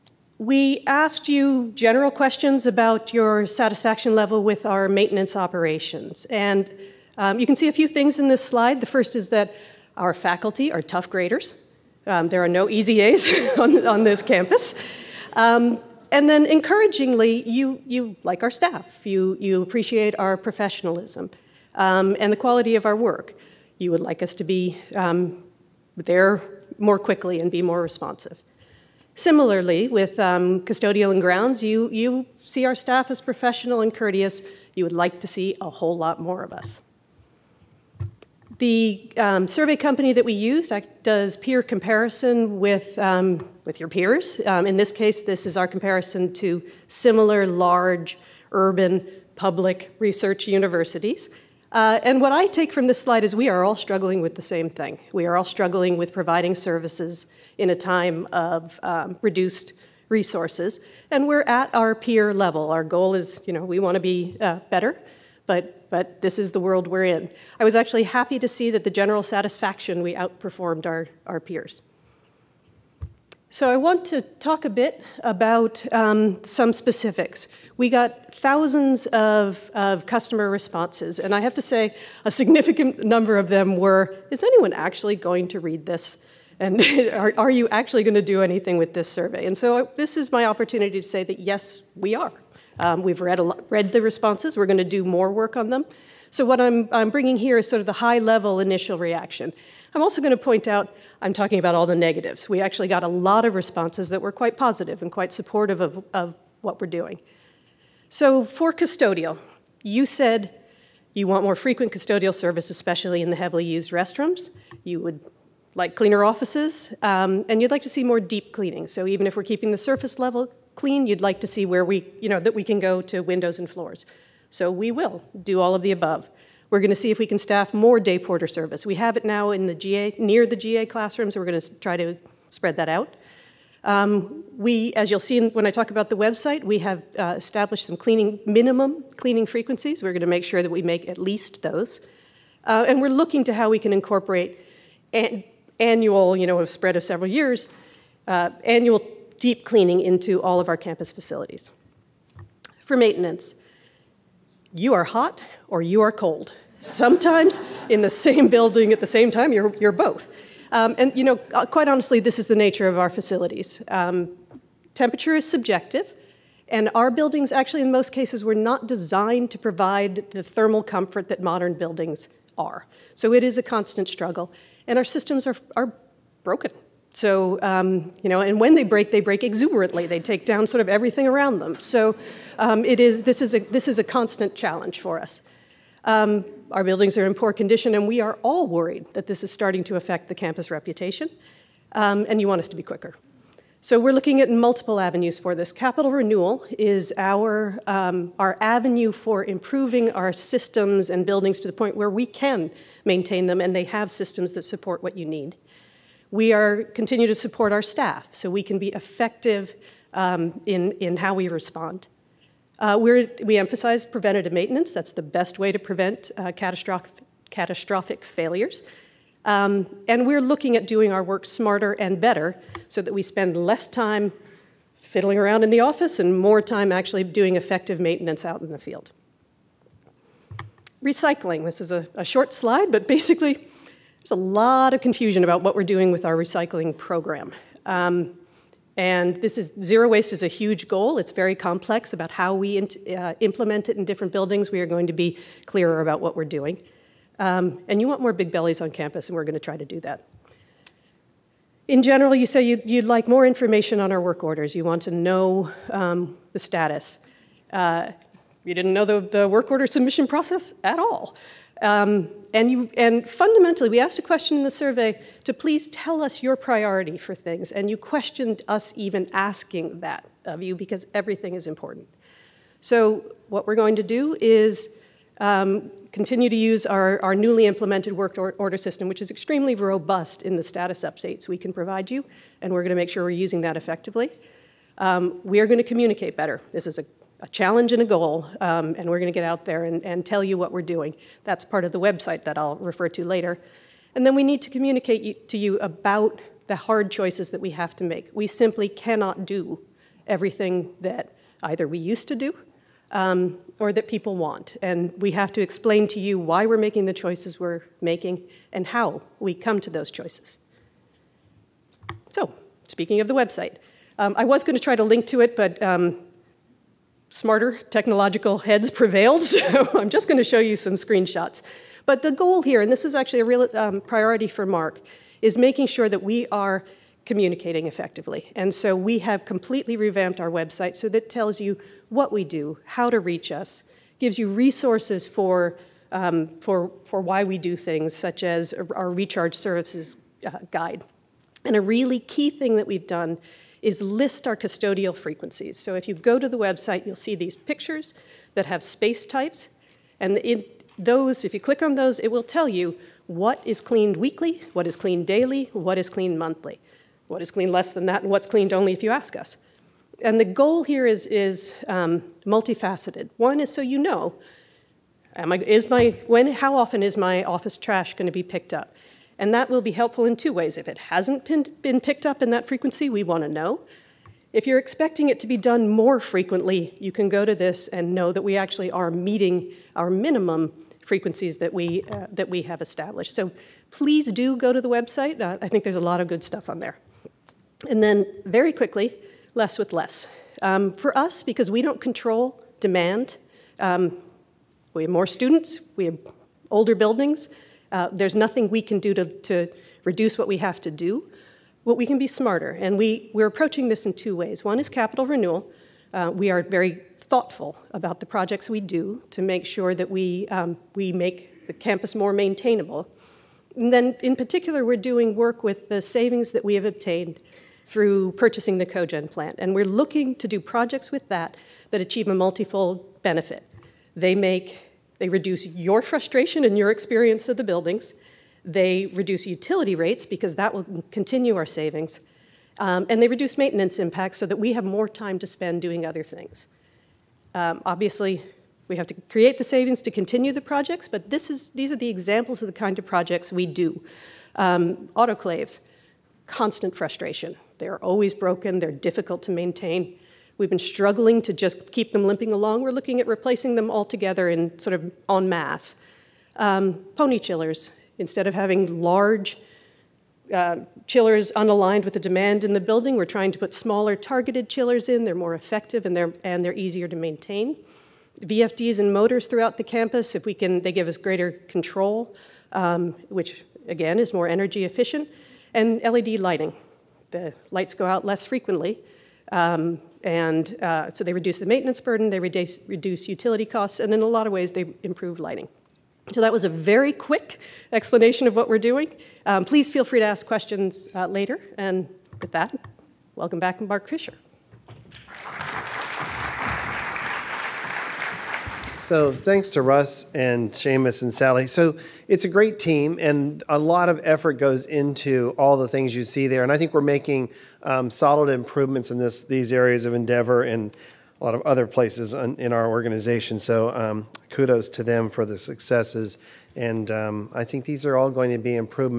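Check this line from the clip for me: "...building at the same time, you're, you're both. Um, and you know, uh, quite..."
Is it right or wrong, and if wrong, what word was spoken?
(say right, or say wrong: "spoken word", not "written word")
right.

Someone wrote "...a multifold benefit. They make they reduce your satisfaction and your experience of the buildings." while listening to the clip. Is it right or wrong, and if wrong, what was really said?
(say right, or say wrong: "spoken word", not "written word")
wrong: "frustration", not "satisfaction".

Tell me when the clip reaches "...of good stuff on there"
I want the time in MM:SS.
06:26.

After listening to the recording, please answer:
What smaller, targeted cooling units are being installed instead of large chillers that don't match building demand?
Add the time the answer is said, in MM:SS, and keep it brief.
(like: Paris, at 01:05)
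pony chillers, at 07:37.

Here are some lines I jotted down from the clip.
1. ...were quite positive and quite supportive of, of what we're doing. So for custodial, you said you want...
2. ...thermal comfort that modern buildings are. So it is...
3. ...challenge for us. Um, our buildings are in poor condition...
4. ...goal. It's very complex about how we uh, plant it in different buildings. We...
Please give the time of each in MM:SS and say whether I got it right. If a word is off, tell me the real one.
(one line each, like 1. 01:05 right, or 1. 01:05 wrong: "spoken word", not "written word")
1. 01:44 right
2. 02:50 right
3. 03:04 right
4. 04:00 wrong: "implement", not "plant".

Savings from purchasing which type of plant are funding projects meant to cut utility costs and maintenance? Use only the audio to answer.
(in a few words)
cogen plant.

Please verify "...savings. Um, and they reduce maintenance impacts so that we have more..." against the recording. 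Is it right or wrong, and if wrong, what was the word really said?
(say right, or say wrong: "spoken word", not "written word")
right.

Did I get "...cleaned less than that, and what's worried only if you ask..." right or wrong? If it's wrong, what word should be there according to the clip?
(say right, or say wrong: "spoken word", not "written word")
wrong: "cleaned", not "worried".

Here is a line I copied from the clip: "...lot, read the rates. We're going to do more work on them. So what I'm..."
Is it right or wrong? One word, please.
wrong.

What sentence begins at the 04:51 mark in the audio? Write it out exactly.
That's part of the website that I'll refer to later.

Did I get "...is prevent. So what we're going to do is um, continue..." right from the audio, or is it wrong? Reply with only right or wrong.
wrong.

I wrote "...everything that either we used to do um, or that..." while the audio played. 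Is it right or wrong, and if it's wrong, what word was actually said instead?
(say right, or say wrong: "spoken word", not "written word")
right.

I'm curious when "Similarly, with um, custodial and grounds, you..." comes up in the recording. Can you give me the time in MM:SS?
00:29.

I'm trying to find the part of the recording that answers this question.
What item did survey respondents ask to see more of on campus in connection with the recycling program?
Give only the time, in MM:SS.
04:08.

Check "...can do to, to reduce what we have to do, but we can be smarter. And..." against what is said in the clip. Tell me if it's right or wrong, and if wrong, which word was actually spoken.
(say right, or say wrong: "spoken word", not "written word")
right.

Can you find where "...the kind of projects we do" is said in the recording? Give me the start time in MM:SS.
07:22.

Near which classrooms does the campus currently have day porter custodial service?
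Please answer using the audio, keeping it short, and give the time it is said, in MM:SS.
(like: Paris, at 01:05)
GA classrooms, at 02:10.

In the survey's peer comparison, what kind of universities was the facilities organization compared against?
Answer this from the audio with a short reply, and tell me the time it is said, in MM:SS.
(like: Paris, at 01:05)
large urban public research universities, at 00:47.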